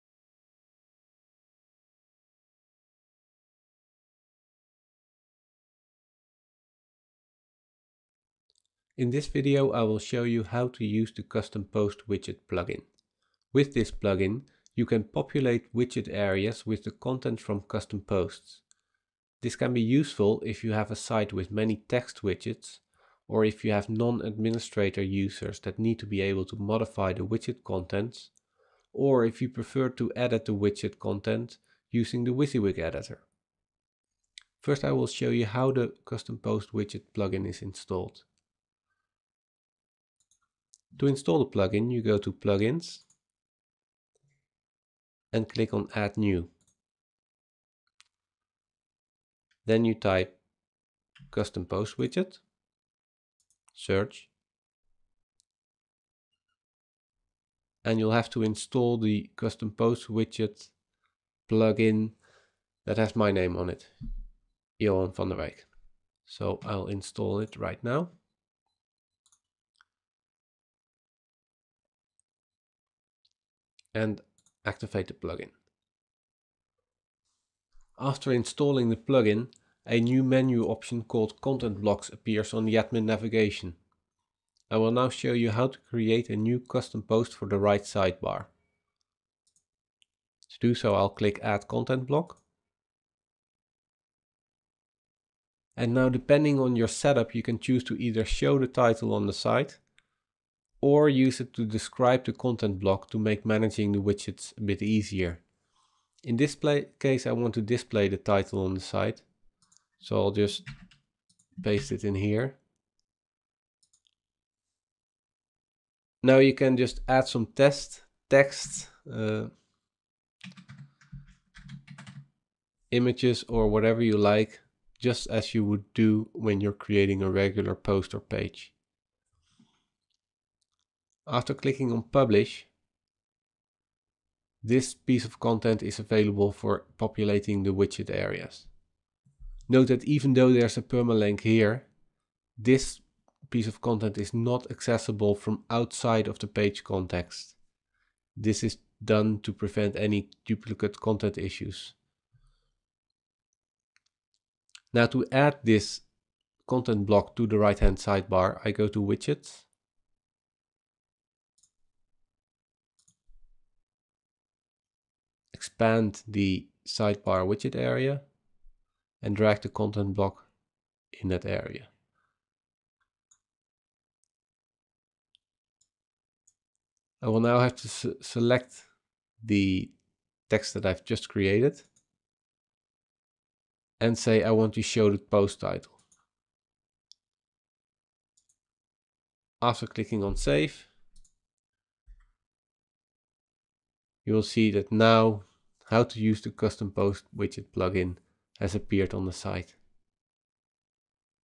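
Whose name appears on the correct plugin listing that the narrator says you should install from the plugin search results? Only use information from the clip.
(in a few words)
Johan van der Wijk.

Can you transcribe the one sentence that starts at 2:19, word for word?
Note that even though there's a permalink here, this piece of content is not accessible from outside of the page context.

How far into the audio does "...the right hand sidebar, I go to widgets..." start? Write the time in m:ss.
2:37.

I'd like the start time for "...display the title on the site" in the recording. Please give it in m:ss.
1:47.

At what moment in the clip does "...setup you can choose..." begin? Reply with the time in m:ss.
1:36.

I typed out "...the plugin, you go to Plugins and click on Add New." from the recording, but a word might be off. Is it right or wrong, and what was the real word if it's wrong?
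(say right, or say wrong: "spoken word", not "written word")
right.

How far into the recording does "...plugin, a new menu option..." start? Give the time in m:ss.
1:18.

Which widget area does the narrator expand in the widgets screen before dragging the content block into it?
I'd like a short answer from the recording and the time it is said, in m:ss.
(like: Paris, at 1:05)
the sidebar widget area, at 2:46.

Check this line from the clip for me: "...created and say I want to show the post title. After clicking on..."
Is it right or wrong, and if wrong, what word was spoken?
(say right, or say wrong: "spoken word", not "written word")
right.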